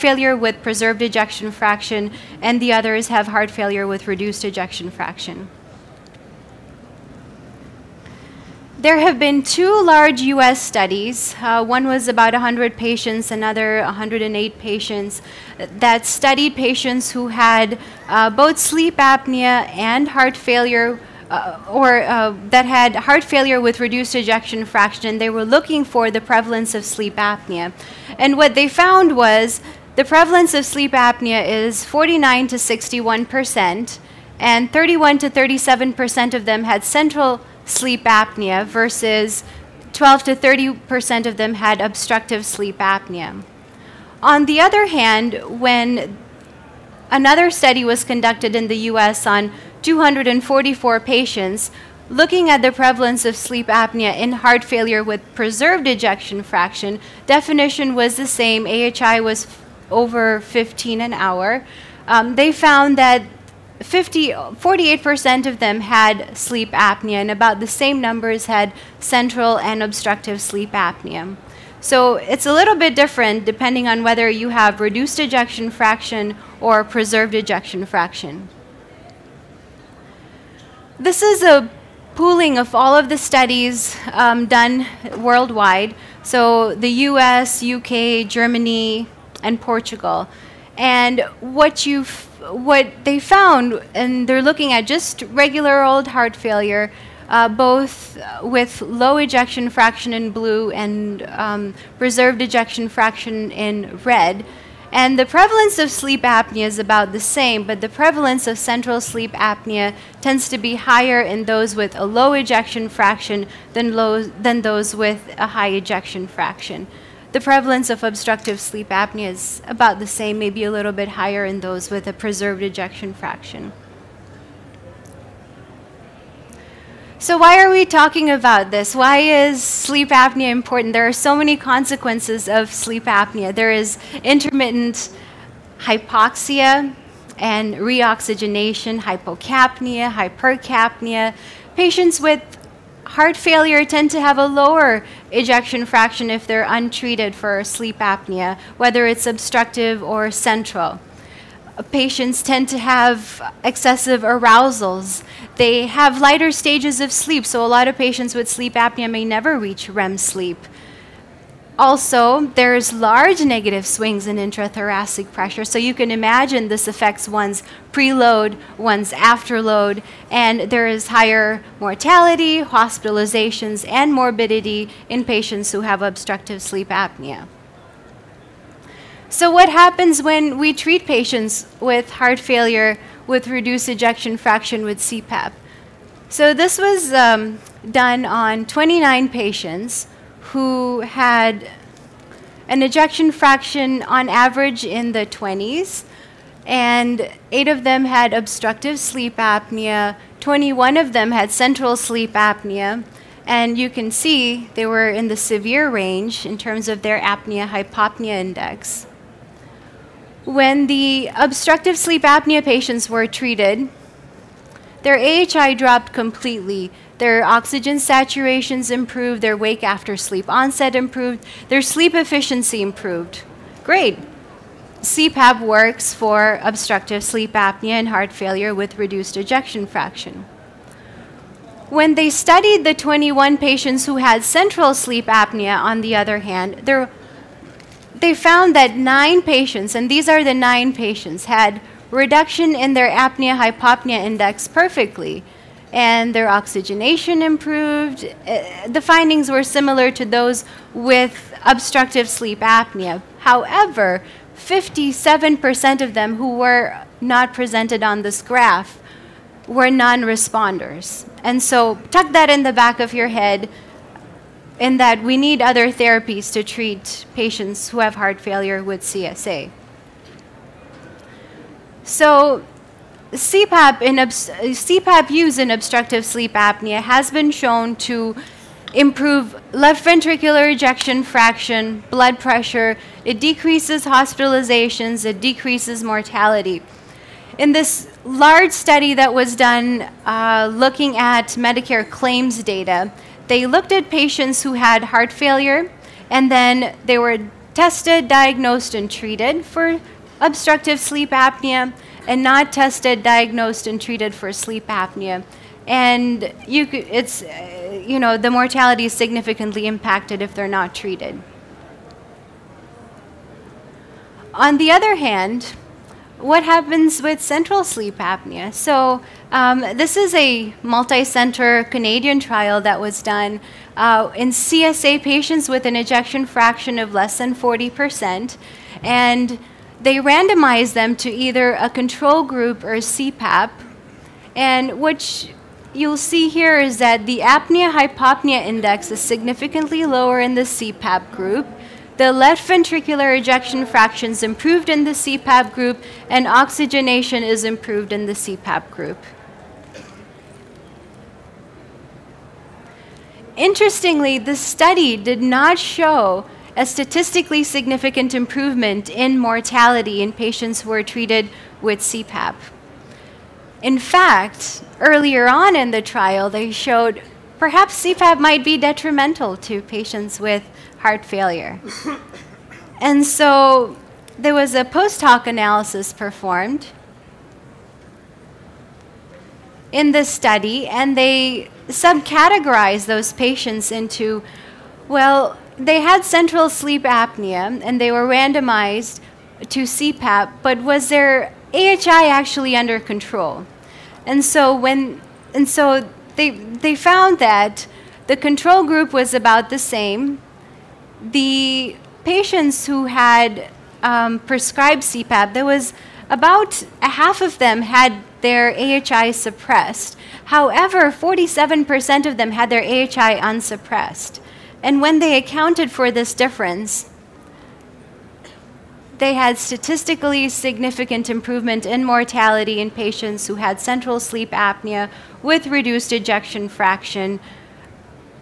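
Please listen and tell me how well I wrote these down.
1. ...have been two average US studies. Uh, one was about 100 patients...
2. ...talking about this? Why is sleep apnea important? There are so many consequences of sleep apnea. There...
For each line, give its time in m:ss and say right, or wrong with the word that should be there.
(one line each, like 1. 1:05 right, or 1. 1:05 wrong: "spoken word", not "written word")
1. 0:08 wrong: "large", not "average"
2. 2:07 right.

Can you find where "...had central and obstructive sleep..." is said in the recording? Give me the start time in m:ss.
1:08.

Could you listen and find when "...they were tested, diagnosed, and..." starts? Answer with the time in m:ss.
4:57.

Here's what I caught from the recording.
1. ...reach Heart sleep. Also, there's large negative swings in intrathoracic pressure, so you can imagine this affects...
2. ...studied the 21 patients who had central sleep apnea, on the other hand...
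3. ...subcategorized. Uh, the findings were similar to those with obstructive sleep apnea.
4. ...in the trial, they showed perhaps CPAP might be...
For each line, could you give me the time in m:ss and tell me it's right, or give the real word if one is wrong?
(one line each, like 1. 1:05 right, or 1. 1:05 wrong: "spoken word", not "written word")
1. 2:39 wrong: "REM", not "Heart"
2. 3:52 right
3. 4:07 wrong: "improved", not "subcategorized"
4. 6:05 right.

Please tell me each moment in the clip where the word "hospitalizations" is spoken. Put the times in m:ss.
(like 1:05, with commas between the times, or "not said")
2:52, 4:44.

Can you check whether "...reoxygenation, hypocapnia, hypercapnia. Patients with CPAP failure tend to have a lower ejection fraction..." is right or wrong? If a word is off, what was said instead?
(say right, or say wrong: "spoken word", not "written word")
wrong: "Heart", not "CPAP".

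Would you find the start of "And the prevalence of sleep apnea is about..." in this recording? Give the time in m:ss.
1:44.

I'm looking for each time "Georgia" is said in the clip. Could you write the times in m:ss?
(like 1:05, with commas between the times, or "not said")
not said.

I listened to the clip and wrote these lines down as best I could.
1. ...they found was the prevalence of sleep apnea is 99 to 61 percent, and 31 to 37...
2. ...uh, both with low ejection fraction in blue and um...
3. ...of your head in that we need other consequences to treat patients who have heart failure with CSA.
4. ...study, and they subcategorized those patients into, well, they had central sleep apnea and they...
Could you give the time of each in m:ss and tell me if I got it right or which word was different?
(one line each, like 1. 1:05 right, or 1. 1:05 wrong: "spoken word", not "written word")
1. 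0:28 wrong: "49", not "99"
2. 1:37 right
3. 4:22 wrong: "therapies", not "consequences"
4. 6:20 right.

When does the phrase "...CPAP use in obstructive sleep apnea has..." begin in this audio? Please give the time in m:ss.
4:34.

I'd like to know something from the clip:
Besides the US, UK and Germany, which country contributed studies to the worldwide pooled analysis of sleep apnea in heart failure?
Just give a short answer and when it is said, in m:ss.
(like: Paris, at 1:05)
Portugal, at 1:29.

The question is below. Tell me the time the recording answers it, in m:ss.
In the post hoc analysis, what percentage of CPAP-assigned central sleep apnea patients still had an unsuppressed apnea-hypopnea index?
6:51.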